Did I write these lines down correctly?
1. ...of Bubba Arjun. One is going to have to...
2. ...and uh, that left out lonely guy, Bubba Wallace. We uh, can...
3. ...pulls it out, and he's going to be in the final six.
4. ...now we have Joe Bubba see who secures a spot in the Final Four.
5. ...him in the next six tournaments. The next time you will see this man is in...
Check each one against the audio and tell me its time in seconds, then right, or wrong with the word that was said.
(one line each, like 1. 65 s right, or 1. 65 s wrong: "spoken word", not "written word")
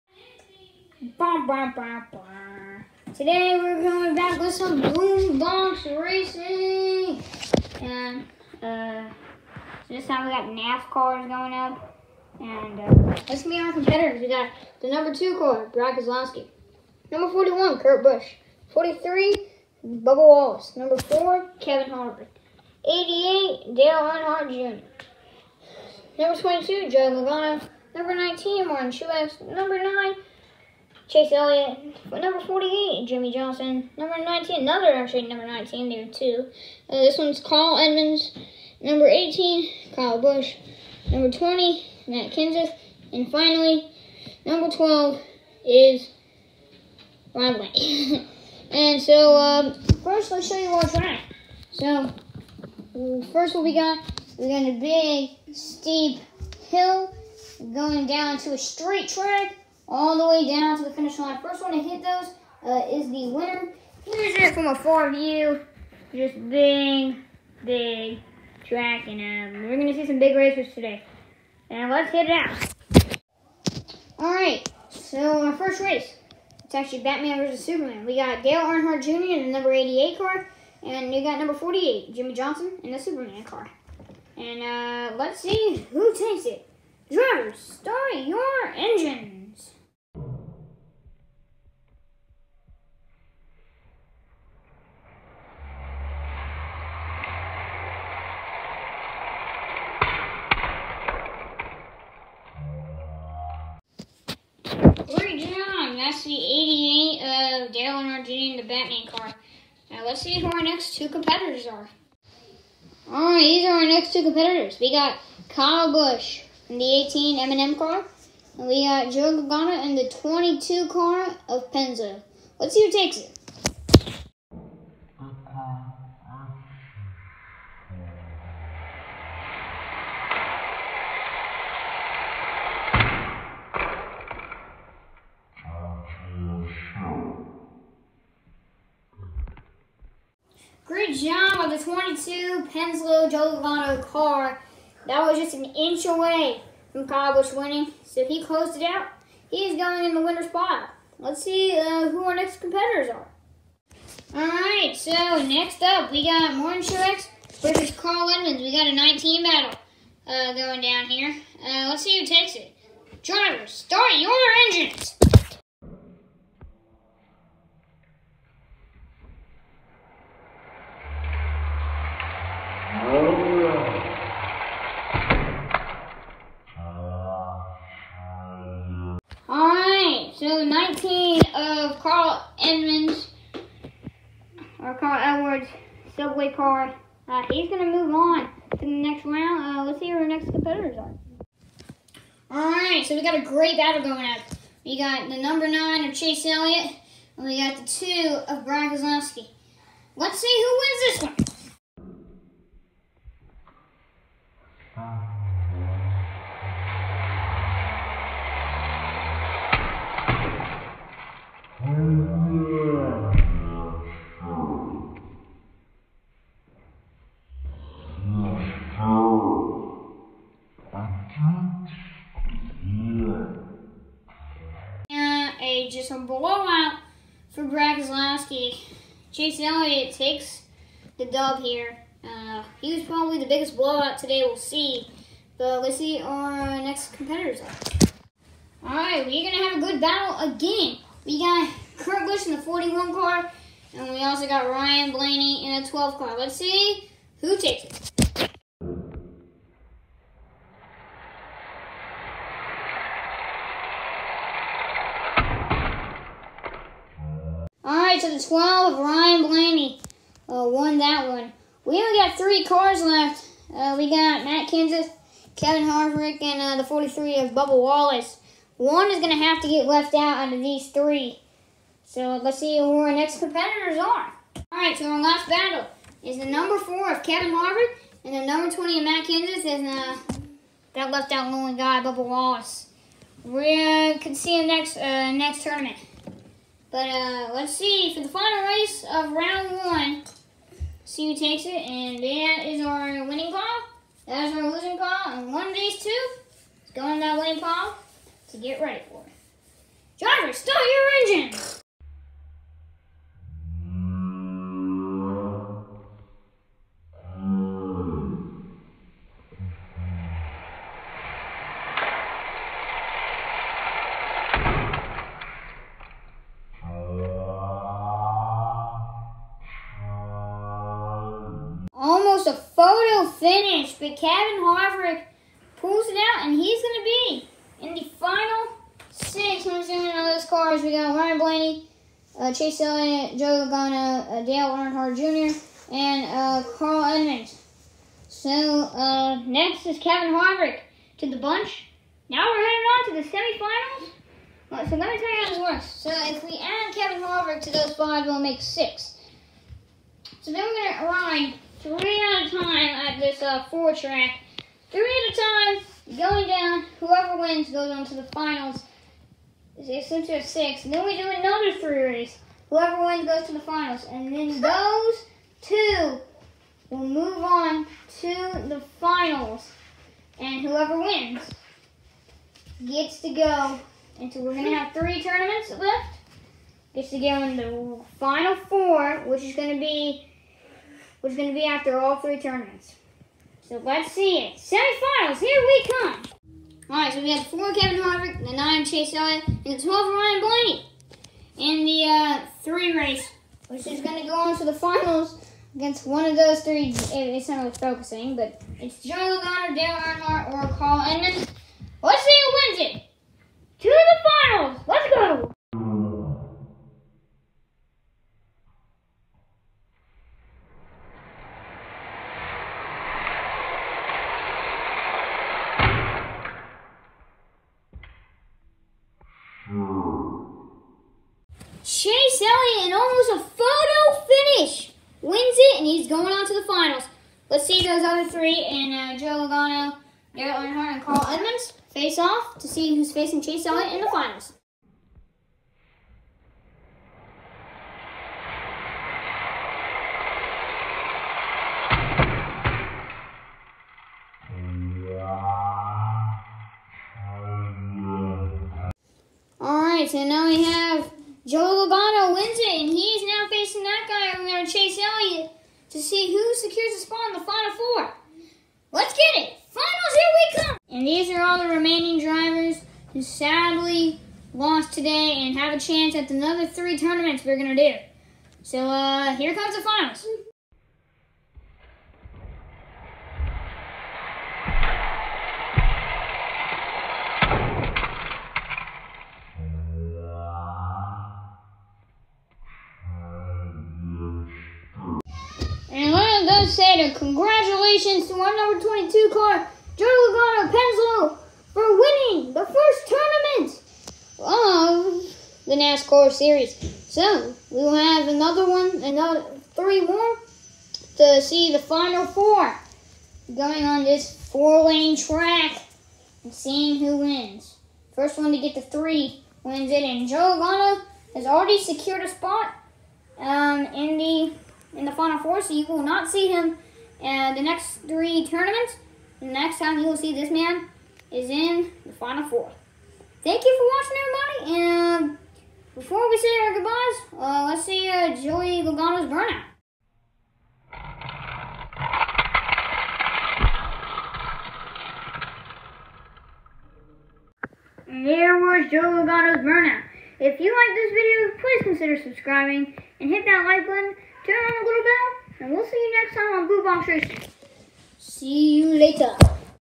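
1. 267 s wrong: "Wallace", not "Arjun"
2. 279 s right
3. 325 s right
4. 450 s wrong: "Logano", not "Bubba"
5. 516 s wrong: "three", not "six".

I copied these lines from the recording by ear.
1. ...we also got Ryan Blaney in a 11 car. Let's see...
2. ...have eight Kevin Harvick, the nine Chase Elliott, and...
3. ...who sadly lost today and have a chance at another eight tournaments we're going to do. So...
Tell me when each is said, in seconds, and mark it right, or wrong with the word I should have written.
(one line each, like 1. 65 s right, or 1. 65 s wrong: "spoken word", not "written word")
1. 244 s wrong: "12", not "11"
2. 387 s wrong: "four", not "eight"
3. 463 s wrong: "three", not "eight".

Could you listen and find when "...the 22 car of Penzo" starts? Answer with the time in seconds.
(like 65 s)
119 s.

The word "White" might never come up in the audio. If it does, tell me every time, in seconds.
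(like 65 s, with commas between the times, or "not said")
47 s.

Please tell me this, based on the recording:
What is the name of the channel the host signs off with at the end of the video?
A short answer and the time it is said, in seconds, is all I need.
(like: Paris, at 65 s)
Blue Bomb Tracy, at 546 s.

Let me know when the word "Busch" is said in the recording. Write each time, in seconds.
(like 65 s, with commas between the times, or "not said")
18 s, 40 s, 115 s, 242 s.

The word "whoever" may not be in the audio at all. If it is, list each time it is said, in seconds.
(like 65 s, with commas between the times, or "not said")
356 s, 362 s, 370 s.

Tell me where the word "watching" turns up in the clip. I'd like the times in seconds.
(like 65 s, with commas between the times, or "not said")
524 s.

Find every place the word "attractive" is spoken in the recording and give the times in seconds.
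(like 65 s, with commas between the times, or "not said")
not said.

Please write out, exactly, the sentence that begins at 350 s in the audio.
So then we're going to align three at a time at this uh, four track.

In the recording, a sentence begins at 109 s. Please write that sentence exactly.
Now let's see who our next two competitors are.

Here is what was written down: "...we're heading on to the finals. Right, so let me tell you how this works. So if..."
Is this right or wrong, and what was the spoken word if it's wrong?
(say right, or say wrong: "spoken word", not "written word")
wrong: "semifinals", not "finals".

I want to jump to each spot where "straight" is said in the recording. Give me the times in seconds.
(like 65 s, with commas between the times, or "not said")
58 s.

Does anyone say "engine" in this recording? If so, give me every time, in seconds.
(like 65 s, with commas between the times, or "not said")
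88 s, 164 s, 301 s.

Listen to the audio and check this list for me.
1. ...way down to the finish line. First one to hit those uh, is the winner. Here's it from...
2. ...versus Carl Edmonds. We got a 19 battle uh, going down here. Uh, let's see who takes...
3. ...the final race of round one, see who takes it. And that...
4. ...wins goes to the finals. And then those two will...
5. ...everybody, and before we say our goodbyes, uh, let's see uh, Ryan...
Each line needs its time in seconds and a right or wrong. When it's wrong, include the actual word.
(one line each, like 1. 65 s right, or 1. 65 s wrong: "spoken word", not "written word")
1. 60 s right
2. 157 s right
3. 288 s right
4. 363 s right
5. 524 s wrong: "Joey", not "Ryan".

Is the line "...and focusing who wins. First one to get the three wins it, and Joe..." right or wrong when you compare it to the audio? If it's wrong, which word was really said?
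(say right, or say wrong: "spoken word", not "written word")
wrong: "seeing", not "focusing".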